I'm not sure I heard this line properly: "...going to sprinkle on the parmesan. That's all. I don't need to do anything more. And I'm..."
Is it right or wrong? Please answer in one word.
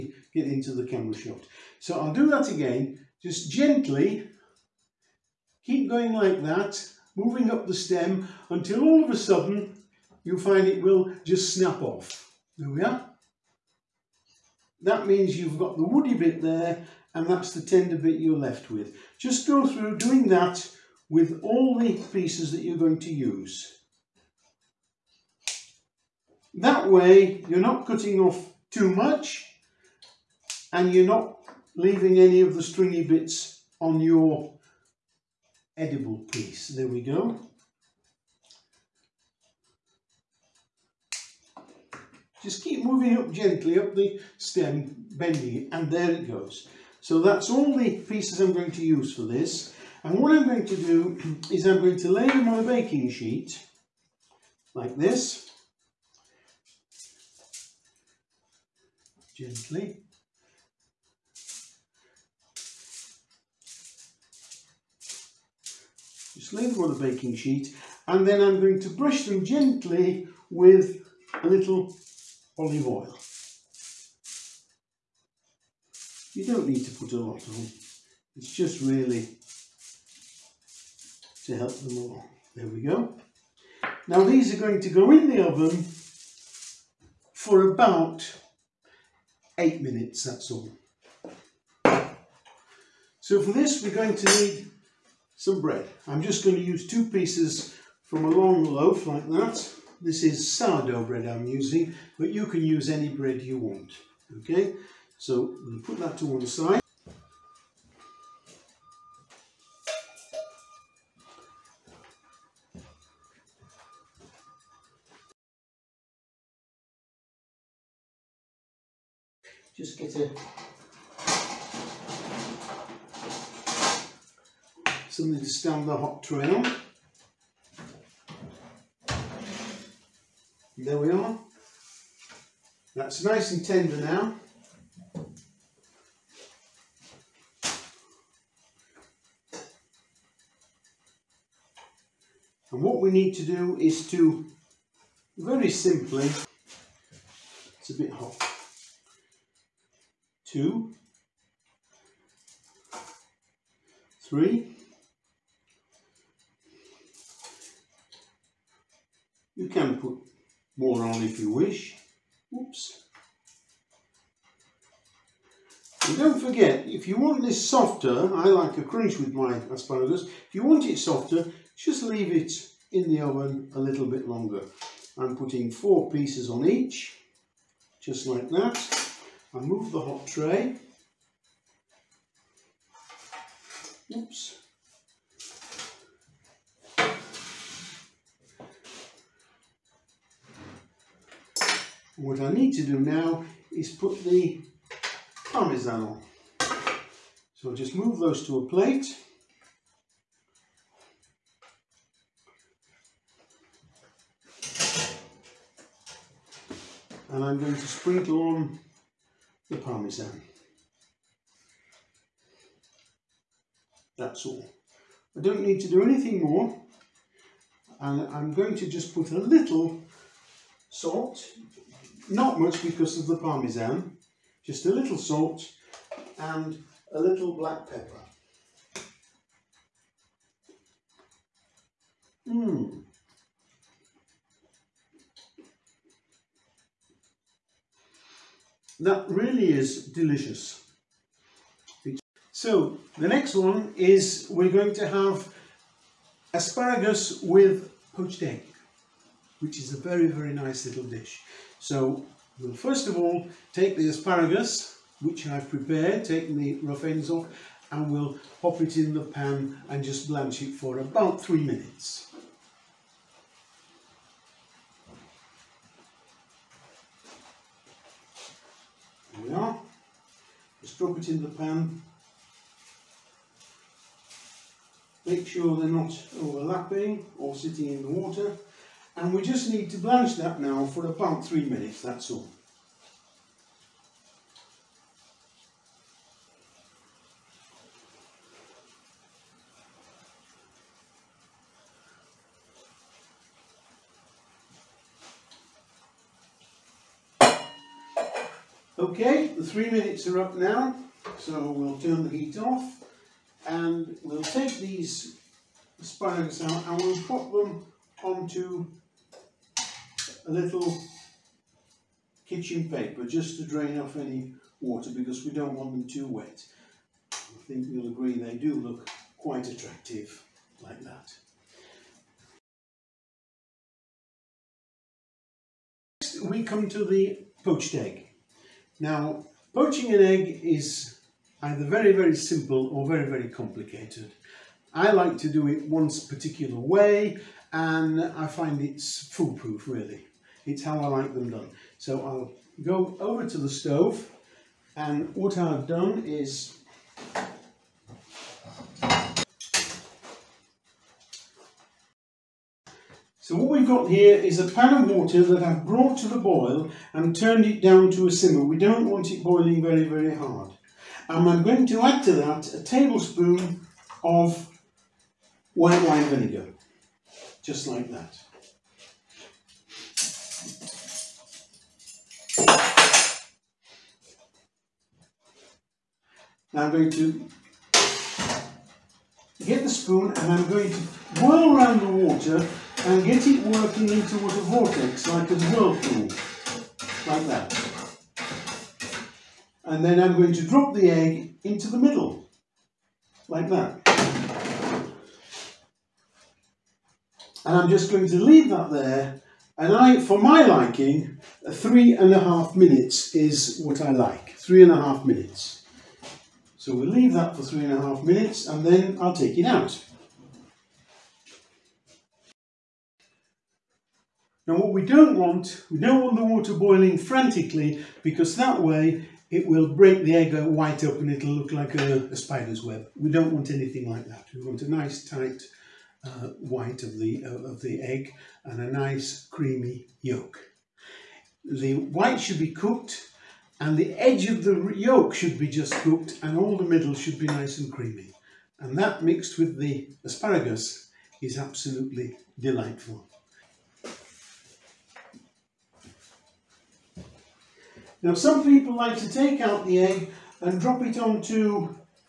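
right.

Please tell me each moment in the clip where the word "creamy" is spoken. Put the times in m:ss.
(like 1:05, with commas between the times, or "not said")
7:09, 7:17.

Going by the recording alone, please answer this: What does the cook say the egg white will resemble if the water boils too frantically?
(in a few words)
A spider's web.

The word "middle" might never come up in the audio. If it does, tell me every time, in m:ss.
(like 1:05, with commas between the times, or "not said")
6:31, 7:16.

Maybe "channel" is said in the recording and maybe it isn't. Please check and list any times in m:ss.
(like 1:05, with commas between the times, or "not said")
not said.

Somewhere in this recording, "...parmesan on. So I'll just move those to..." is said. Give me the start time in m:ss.
3:15.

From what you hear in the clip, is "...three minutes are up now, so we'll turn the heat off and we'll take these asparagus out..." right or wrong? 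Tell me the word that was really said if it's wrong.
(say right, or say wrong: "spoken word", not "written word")
right.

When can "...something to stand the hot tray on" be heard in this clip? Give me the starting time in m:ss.
2:05.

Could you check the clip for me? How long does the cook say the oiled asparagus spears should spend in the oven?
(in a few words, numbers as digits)
8 minutes.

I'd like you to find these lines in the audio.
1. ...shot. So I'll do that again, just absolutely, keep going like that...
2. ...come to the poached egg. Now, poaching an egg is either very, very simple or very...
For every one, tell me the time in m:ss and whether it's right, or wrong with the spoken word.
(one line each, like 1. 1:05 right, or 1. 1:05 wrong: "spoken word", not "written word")
1. 0:01 wrong: "gently", not "absolutely"
2. 5:26 right.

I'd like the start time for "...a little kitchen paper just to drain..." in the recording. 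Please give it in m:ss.
5:10.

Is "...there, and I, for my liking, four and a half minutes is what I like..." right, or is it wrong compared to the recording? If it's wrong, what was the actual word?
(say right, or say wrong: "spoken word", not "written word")
wrong: "three", not "four".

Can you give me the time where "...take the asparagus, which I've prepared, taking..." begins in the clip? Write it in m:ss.
4:13.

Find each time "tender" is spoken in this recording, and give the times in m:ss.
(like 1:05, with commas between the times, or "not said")
0:17, 2:13.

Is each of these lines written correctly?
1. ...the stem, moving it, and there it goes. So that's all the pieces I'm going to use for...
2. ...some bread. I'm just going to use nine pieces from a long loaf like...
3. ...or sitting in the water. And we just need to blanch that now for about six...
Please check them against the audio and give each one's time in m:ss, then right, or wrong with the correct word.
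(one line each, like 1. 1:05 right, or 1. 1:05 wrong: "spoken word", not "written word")
1. 0:43 wrong: "bending", not "moving"
2. 1:35 wrong: "two", not "nine"
3. 4:37 wrong: "three", not "six".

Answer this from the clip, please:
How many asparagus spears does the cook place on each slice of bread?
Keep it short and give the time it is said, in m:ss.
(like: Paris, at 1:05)
4, at 2:55.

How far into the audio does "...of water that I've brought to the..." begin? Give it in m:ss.
5:55.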